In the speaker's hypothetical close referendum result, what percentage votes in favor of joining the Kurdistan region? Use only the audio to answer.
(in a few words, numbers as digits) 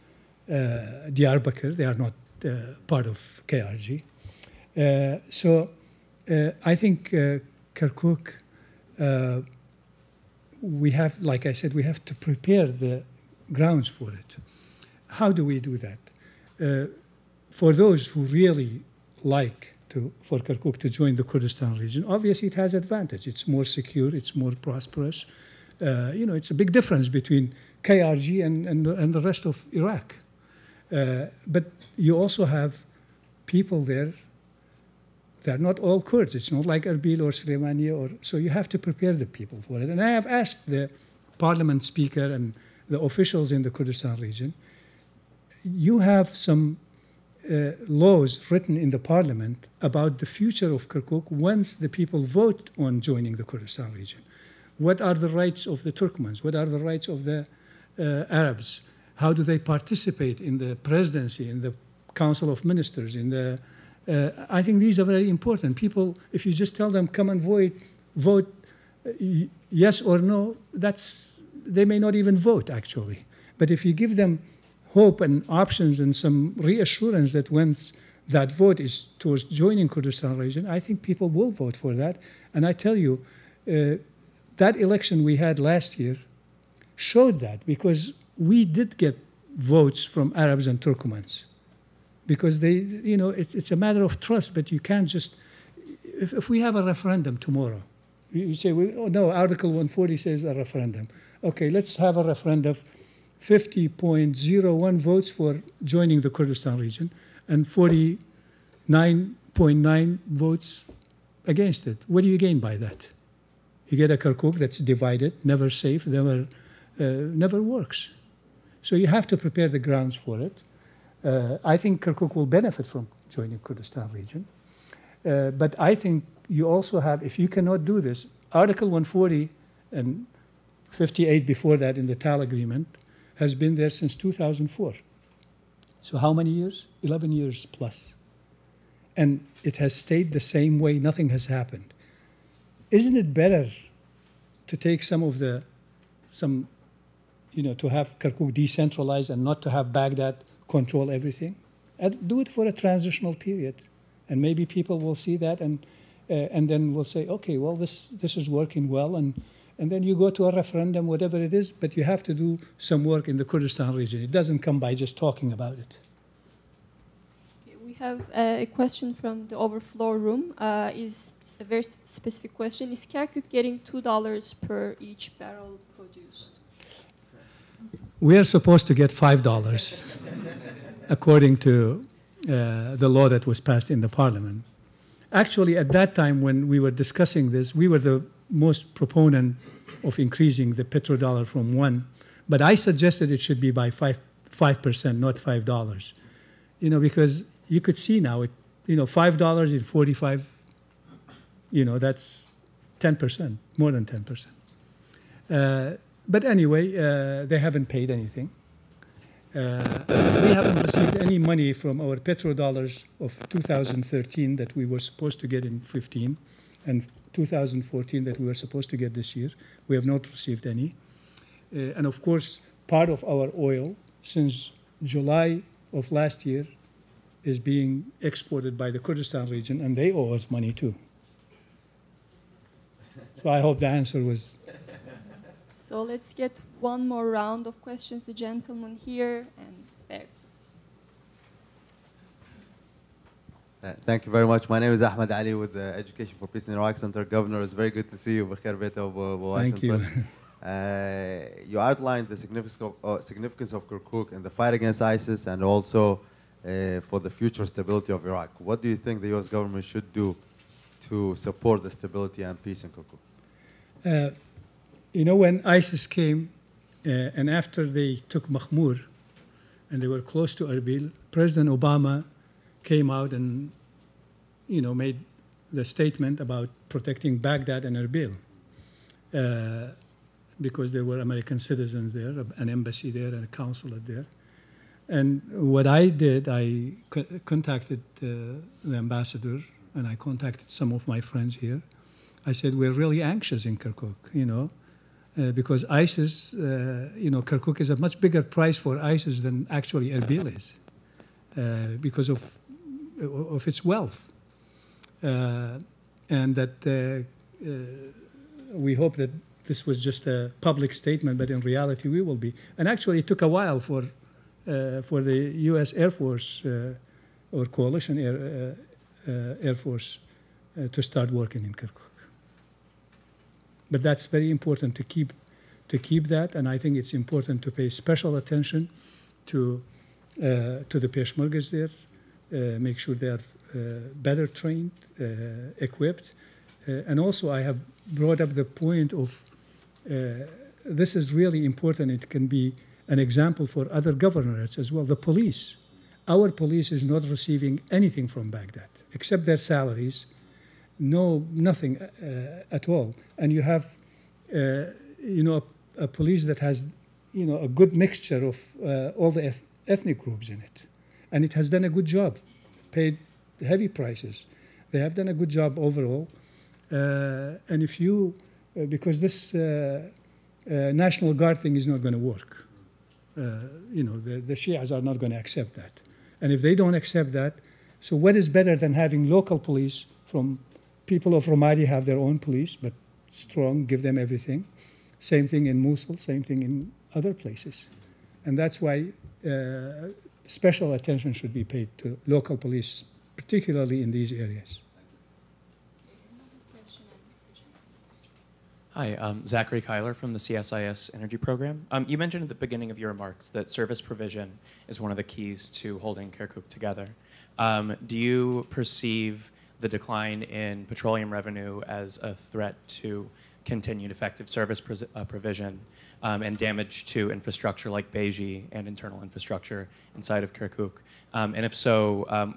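50.01.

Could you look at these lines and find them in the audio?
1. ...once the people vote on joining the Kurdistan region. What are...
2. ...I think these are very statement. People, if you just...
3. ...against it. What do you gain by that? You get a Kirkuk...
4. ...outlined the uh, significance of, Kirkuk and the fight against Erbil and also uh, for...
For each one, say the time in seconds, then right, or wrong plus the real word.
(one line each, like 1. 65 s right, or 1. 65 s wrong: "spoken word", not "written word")
1. 51 s right
2. 64 s wrong: "important", not "statement"
3. 111 s right
4. 251 s wrong: "ISIS", not "Erbil".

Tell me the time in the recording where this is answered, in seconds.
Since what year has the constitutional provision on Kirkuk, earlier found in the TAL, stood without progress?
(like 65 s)
134 s.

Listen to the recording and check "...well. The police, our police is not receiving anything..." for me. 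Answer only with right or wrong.
right.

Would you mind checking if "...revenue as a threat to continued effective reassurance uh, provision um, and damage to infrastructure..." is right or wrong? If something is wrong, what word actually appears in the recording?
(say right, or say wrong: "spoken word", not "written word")
wrong: "service", not "reassurance".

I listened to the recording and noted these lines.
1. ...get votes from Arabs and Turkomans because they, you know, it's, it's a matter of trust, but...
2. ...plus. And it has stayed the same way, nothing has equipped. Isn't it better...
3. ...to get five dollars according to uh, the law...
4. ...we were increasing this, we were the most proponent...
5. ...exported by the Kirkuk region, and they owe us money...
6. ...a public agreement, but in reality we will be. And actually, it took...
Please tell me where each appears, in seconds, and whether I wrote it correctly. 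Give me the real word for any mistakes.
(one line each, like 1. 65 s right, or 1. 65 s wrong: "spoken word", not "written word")
1. 88 s right
2. 137 s wrong: "happened", not "equipped"
3. 178 s right
4. 186 s wrong: "discussing", not "increasing"
5. 228 s wrong: "Kurdistan", not "Kirkuk"
6. 310 s wrong: "statement", not "agreement".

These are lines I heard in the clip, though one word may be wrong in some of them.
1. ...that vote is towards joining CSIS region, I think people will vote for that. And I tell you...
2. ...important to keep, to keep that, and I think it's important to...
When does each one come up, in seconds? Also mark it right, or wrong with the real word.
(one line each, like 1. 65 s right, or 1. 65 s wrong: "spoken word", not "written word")
1. 78 s wrong: "Kurdistan", not "CSIS"
2. 324 s right.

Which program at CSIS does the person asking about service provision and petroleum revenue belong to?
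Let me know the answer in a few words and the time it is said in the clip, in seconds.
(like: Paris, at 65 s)
Energy Program, at 401 s.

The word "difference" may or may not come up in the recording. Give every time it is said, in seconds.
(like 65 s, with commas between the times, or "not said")
26 s.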